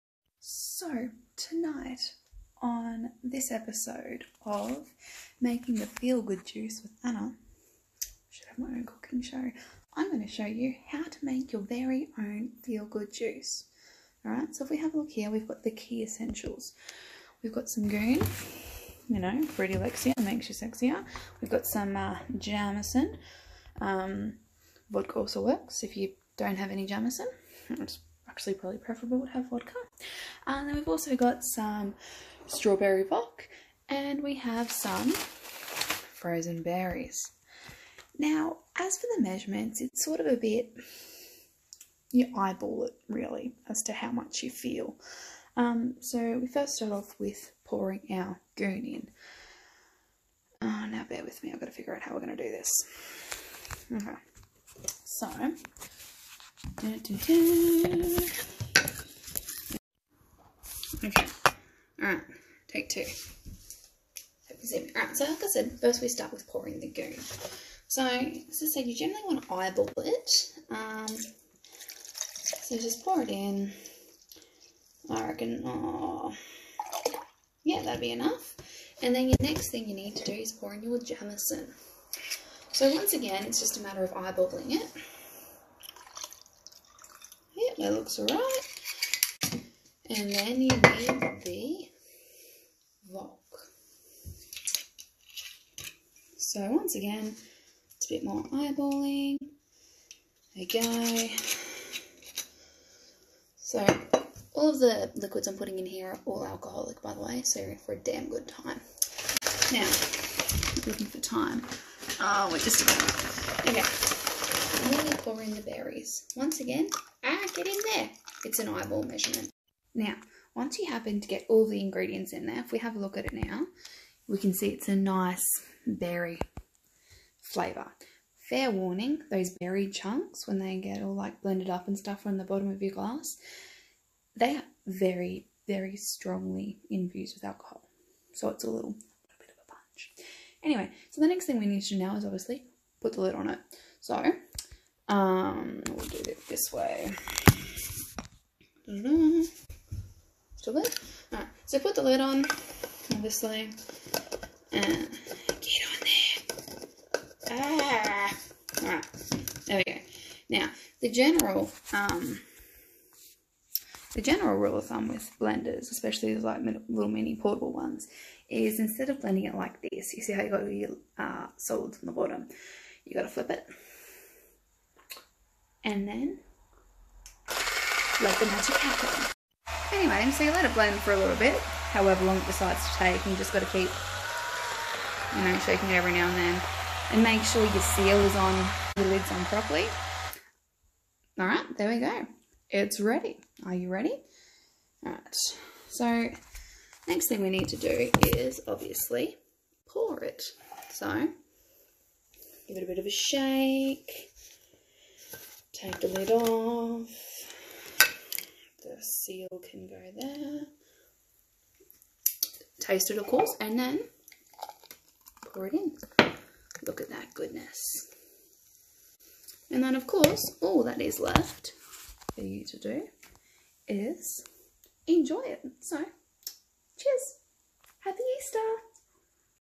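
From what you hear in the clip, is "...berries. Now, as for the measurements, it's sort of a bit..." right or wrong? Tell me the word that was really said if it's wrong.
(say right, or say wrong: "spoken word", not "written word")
right.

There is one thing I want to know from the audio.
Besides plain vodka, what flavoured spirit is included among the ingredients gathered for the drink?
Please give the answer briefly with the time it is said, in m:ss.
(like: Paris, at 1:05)
strawberry vodka, at 0:32.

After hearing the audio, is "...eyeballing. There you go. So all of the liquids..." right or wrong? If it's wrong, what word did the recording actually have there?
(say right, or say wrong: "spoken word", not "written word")
right.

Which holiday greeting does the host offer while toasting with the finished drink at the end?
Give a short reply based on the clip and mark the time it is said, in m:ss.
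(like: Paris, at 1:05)
Happy Easter, at 3:48.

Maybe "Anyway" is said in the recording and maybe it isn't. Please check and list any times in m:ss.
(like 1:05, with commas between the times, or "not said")
2:20, 2:59.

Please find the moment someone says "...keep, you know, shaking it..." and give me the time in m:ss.
3:03.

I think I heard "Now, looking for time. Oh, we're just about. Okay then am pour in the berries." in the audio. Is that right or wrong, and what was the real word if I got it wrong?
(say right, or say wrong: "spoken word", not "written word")
right.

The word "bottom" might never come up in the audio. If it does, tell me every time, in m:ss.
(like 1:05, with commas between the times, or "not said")
2:12, 2:52.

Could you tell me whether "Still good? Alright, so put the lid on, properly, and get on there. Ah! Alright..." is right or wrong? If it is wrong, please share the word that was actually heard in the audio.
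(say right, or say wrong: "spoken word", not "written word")
wrong: "obviously", not "properly".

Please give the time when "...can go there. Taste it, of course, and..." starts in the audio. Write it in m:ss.
3:29.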